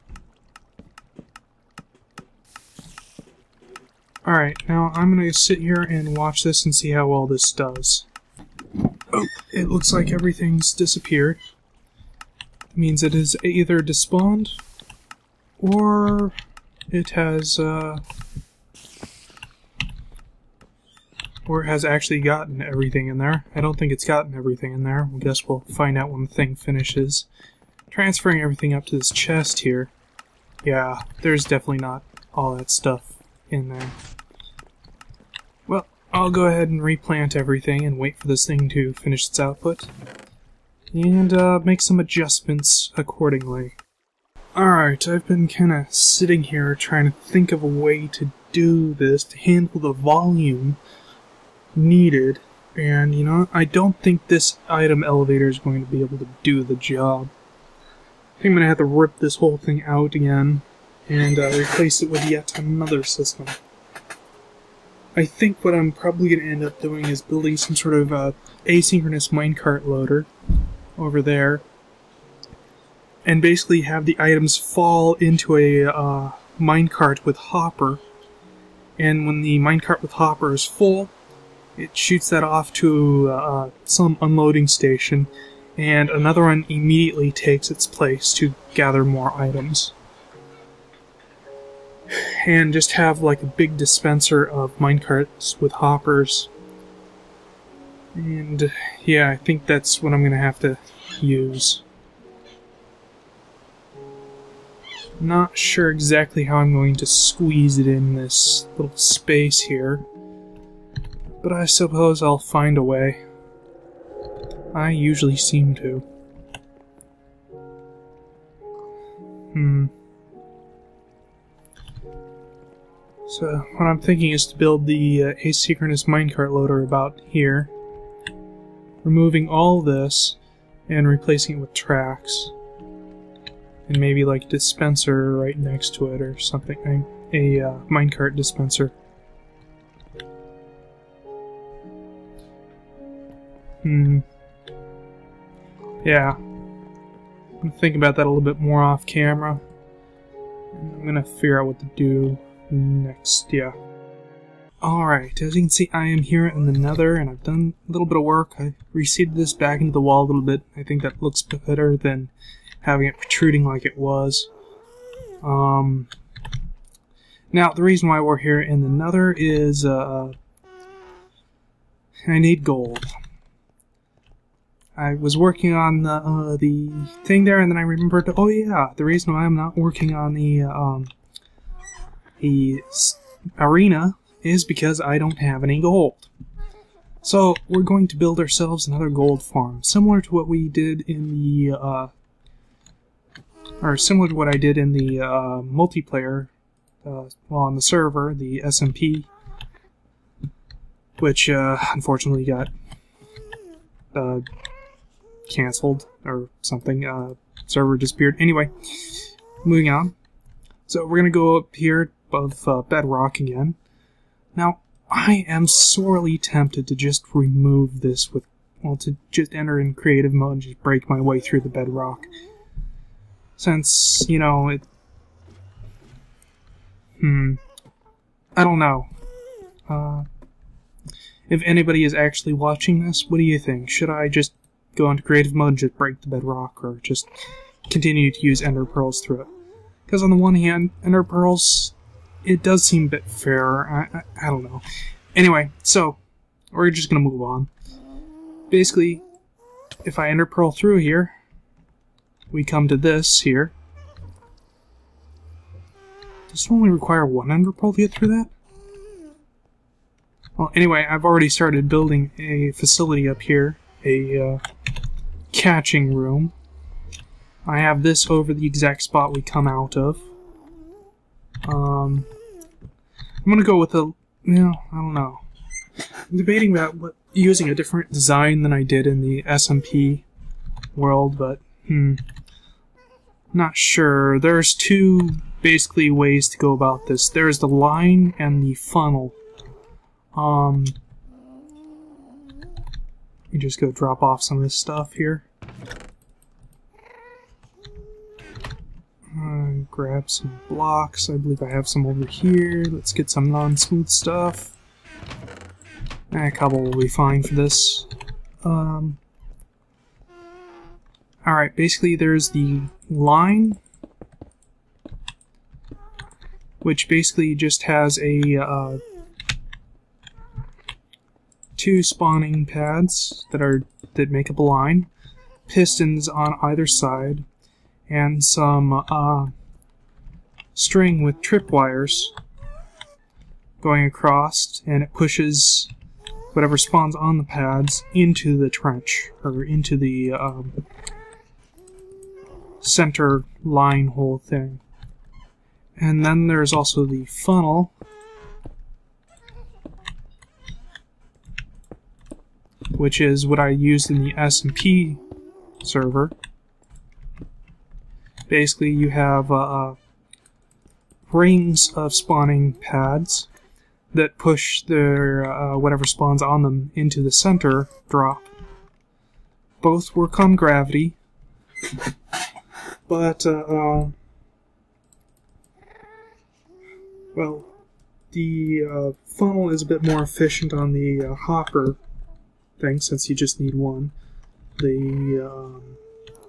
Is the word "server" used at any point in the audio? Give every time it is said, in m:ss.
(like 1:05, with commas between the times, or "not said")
3:17, 3:27, 5:55.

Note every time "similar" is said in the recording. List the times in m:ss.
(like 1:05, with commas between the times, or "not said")
3:09, 3:13.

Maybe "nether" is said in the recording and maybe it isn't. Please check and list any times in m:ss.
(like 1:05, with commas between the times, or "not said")
2:36, 2:48.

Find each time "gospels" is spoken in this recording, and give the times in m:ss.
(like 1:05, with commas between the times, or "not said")
not said.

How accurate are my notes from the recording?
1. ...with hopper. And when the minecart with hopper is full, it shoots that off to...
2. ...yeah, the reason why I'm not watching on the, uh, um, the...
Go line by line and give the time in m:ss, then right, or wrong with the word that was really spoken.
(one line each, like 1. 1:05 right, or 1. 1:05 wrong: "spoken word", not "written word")
1. 1:17 right
2. 2:58 wrong: "working", not "watching".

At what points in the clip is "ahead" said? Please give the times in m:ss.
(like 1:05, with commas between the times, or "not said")
0:36.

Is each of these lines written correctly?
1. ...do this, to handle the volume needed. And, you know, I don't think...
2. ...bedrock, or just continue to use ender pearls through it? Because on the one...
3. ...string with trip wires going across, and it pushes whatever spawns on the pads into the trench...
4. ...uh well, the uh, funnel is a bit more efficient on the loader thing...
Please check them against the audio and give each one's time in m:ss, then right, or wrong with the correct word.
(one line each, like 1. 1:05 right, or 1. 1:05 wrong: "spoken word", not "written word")
1. 0:48 right
2. 3:56 right
3. 5:30 right
4. 6:13 wrong: "hopper", not "loader".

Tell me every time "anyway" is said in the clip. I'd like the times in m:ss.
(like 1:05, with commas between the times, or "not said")
3:28, 4:05, 4:20.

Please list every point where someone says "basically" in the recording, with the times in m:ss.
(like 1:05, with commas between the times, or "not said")
1:13, 4:08, 4:45, 5:11, 5:17, 5:58.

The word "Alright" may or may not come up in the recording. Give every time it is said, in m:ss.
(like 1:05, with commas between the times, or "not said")
0:04, 0:44, 2:34, 5:11.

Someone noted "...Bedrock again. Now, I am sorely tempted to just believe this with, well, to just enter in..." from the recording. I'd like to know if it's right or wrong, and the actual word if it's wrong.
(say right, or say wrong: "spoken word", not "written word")
wrong: "remove", not "believe".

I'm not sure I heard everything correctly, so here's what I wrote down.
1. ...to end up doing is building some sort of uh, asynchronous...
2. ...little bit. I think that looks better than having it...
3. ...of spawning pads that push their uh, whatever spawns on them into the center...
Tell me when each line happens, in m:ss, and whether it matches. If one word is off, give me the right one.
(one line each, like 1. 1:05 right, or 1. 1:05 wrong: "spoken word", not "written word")
1. 1:06 right
2. 2:40 right
3. 6:01 right.